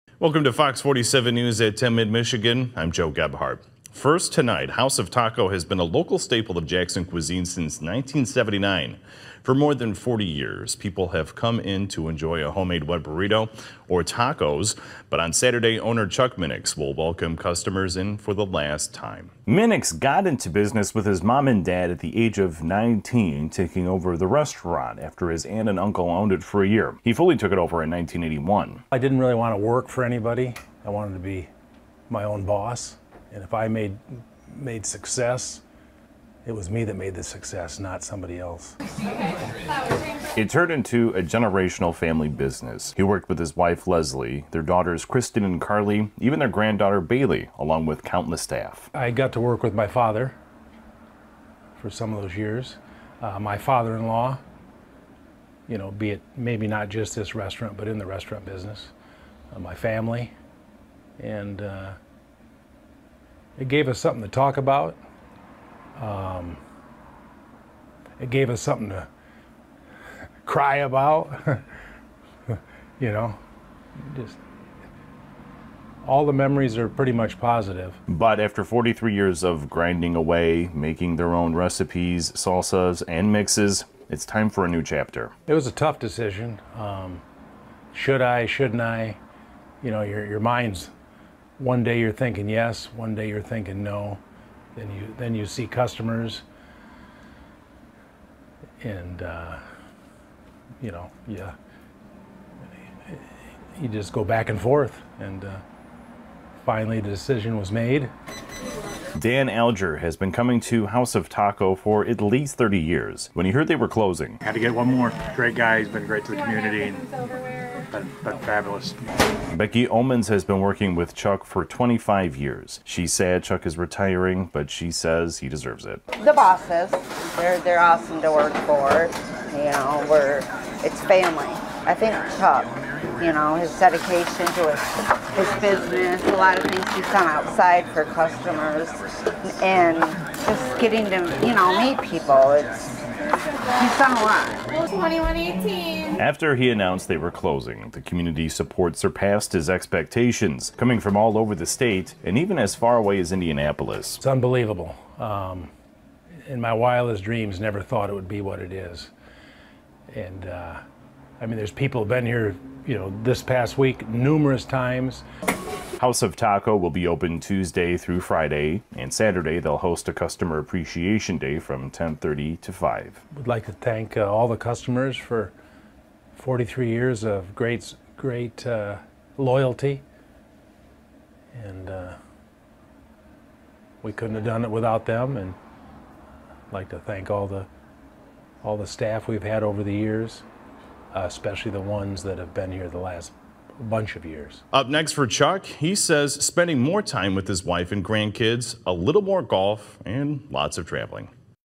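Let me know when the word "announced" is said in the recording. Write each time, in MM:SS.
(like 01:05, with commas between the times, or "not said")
02:26.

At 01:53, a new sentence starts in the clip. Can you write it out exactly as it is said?
When he heard they were closing, had to get one more.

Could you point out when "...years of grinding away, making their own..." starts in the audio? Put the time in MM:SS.
01:19.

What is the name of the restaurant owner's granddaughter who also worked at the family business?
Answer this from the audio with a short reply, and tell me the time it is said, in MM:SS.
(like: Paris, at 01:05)
Bailey, at 00:46.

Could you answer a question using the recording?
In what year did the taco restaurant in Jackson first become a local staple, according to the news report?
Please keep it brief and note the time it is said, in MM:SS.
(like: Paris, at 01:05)
1979, at 00:07.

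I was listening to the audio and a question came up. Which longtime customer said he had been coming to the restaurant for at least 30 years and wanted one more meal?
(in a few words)
Dan Alger.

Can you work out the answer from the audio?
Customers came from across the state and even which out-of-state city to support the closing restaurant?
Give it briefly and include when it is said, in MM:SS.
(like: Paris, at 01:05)
Indianapolis, at 02:33.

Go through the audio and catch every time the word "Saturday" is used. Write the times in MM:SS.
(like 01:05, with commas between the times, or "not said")
00:15, 02:49.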